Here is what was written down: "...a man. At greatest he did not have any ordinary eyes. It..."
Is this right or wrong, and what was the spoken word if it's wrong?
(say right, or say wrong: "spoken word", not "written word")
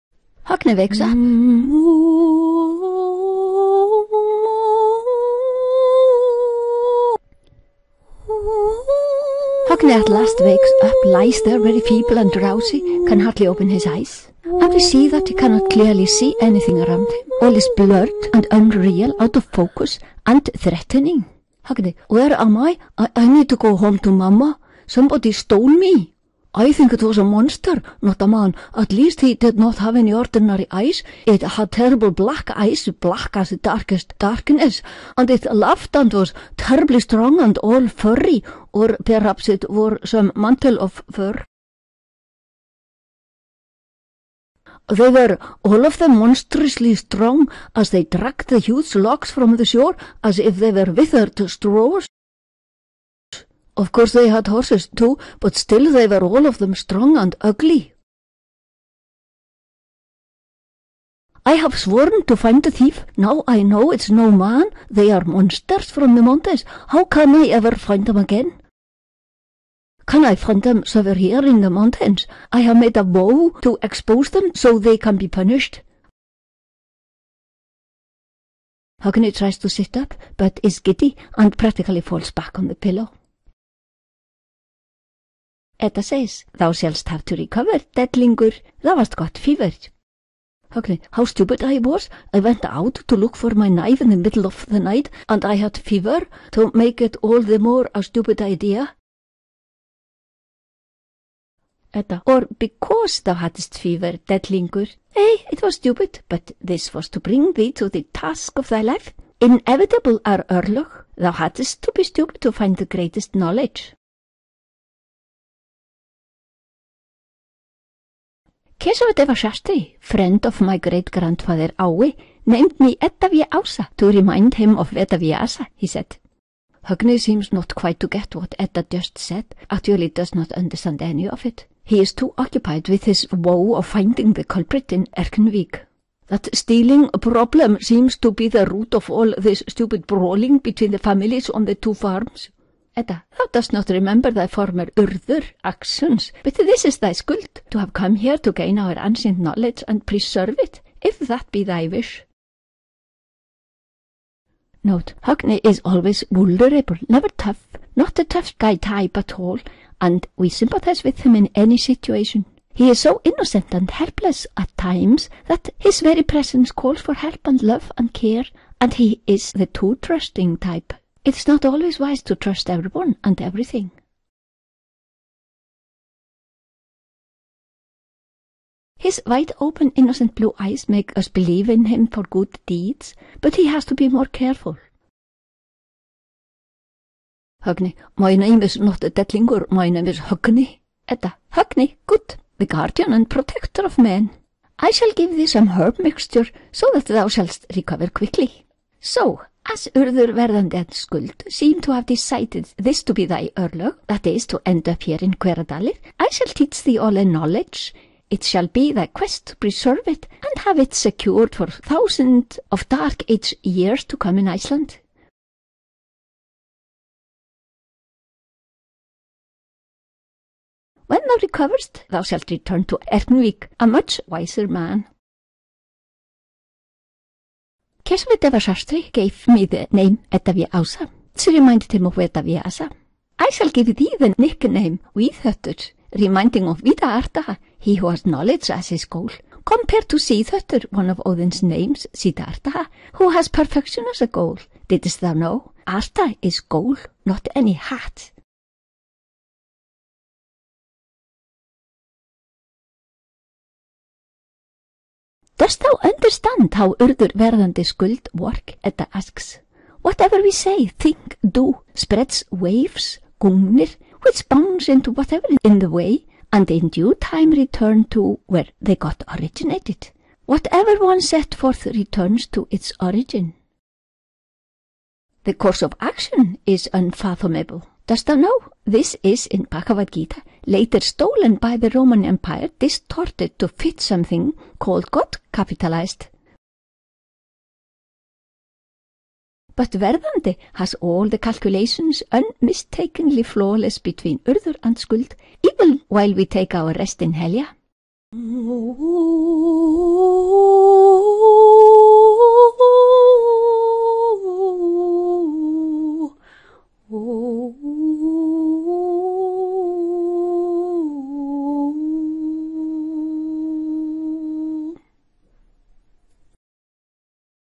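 wrong: "least", not "greatest".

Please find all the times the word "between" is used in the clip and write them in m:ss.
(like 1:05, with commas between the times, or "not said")
2:20, 4:53.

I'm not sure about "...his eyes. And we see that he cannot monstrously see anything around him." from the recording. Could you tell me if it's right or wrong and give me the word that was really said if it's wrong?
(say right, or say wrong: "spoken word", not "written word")
wrong: "clearly", not "monstrously".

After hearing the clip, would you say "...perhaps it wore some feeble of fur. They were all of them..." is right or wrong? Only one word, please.
wrong.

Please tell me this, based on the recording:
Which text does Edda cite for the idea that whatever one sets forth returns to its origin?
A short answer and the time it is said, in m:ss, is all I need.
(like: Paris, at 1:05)
Bhagavad Gita, at 4:39.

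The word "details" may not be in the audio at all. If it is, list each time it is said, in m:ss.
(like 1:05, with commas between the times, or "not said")
not said.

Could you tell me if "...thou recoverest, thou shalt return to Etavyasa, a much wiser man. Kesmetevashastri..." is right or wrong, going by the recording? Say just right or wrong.
wrong.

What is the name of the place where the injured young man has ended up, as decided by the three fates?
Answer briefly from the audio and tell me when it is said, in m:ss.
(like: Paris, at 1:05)
Hveradalir, at 3:25.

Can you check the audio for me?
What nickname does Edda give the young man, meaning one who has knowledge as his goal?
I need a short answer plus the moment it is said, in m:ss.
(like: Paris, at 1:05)
Viðhöttur, at 3:55.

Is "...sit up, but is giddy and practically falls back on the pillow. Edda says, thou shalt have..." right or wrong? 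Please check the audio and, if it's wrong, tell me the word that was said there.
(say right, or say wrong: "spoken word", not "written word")
right.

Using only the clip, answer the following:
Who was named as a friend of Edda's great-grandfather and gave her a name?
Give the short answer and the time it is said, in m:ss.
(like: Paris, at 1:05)
Keshav Deva Shastri, at 1:58.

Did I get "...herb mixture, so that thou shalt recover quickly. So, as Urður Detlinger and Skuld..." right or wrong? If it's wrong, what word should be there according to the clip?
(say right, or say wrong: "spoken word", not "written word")
wrong: "Verðandi", not "Detlinger".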